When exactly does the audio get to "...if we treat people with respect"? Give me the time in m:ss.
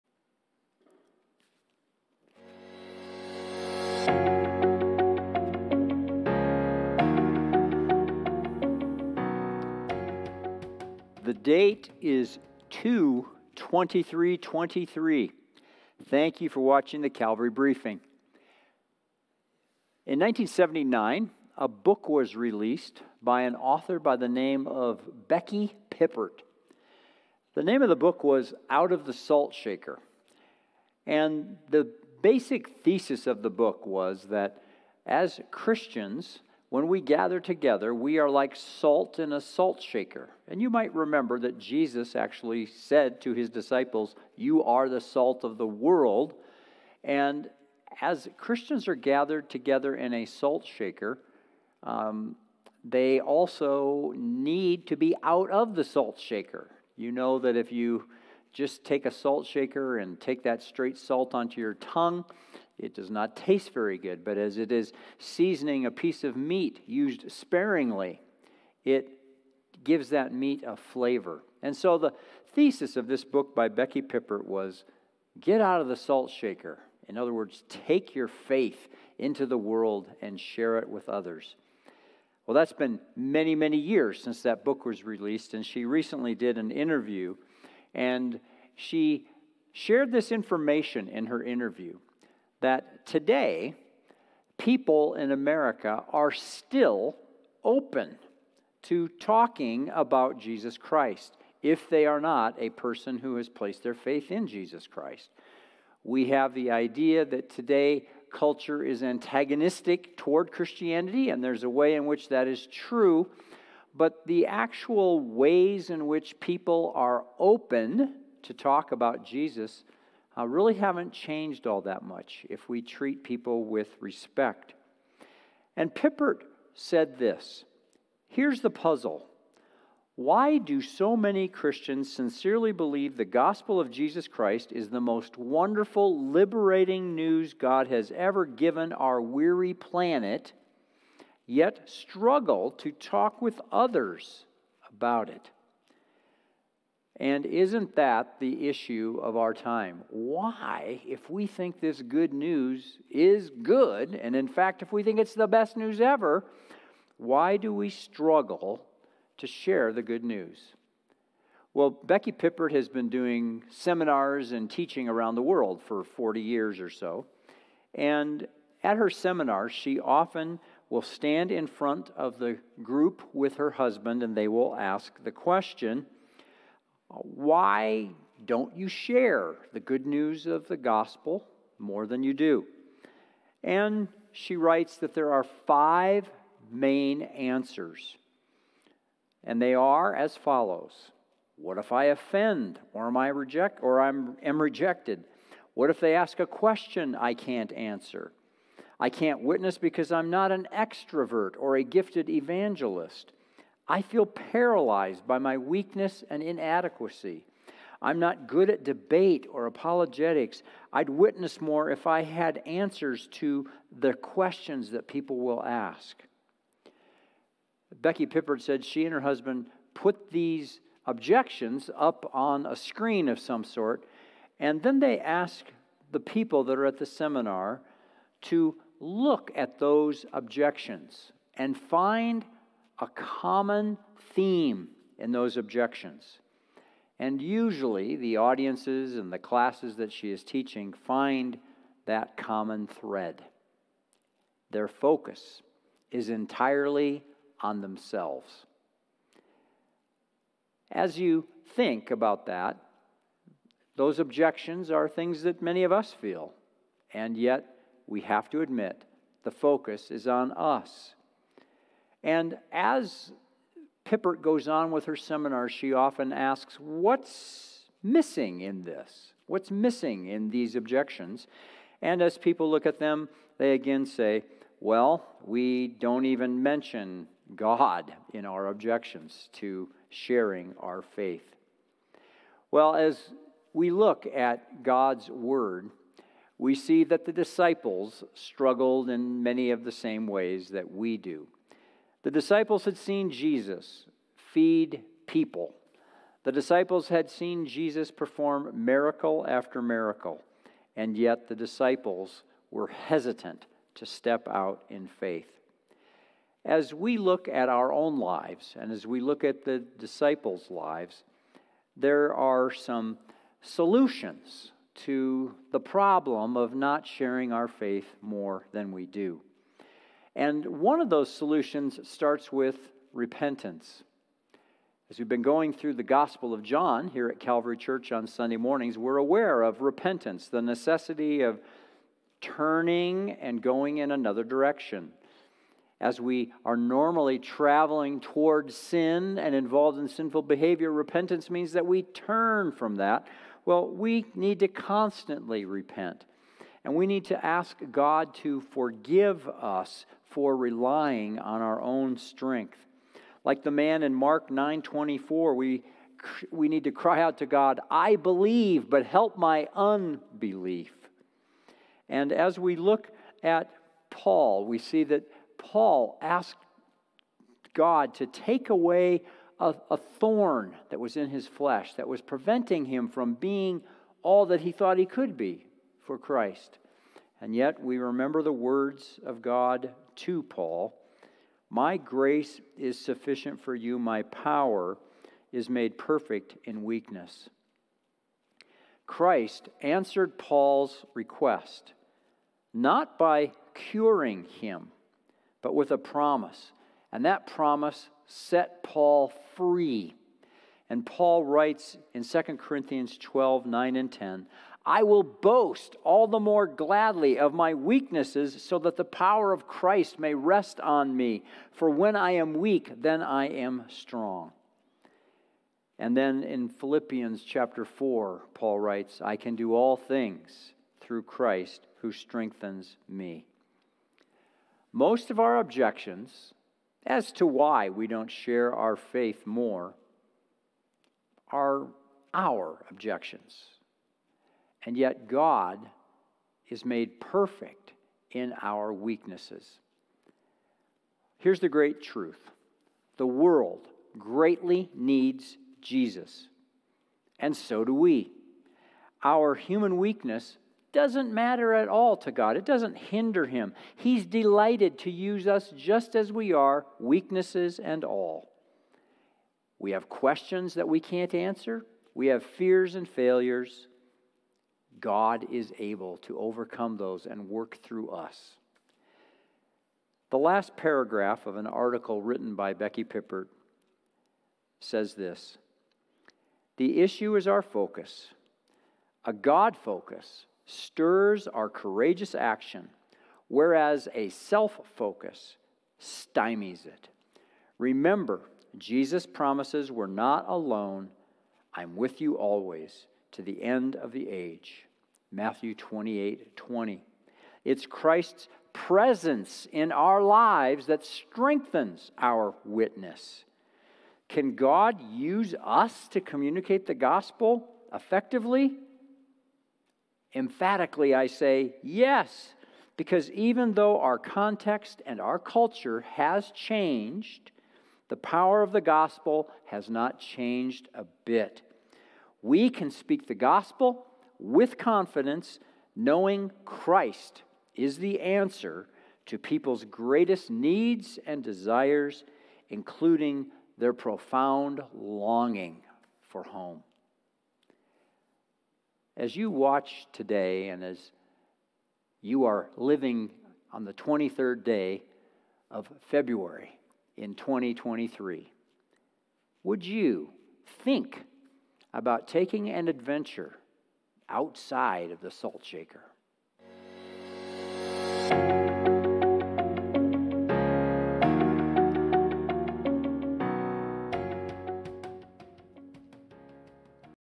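2:02.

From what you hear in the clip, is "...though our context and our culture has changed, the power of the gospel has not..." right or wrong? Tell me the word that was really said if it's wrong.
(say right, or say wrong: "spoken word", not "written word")
right.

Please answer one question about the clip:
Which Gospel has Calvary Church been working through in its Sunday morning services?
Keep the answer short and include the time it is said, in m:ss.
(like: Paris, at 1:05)
Gospel of John, at 5:26.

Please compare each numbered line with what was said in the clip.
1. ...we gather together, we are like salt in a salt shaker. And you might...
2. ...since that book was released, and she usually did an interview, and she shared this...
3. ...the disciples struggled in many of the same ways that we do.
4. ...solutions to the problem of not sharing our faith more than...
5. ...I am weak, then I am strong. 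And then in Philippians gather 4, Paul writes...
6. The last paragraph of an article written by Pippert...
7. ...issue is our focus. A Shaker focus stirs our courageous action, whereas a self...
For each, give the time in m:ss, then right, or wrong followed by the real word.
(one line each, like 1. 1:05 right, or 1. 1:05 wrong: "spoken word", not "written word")
1. 0:36 right
2. 1:24 wrong: "recently", not "usually"
3. 4:47 right
4. 5:13 right
5. 6:52 wrong: "chapter", not "gather"
6. 7:50 wrong: "Becky", not "Pippert"
7. 7:57 wrong: "God", not "Shaker".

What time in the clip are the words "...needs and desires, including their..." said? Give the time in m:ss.
8:50.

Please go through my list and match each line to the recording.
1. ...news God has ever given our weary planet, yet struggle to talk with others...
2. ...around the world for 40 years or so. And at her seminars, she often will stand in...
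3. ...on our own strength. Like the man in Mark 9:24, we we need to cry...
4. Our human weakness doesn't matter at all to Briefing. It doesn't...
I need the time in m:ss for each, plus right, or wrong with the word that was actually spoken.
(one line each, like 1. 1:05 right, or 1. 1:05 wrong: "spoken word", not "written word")
1. 2:17 right
2. 2:45 right
3. 5:51 right
4. 7:29 wrong: "God", not "Briefing".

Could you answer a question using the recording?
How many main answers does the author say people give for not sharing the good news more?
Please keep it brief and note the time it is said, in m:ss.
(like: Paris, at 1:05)
5, at 3:05.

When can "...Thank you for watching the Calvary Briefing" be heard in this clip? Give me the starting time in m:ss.
0:16.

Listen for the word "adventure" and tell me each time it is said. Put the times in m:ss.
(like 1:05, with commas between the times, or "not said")
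9:12.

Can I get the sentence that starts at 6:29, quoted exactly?
Christ answered Paul's request not by curing him, but with a promise.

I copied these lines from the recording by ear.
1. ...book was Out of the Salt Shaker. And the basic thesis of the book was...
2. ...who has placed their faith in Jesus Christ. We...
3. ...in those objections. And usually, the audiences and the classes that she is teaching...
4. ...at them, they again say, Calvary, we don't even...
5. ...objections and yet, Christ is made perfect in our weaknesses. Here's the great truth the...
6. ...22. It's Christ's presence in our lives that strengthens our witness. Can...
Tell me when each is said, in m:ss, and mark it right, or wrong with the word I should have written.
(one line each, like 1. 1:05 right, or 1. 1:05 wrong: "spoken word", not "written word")
1. 0:27 right
2. 1:43 right
3. 3:55 right
4. 4:32 wrong: "Well", not "Calvary"
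5. 7:12 wrong: "God", not "Christ"
6. 8:16 wrong: "20", not "22".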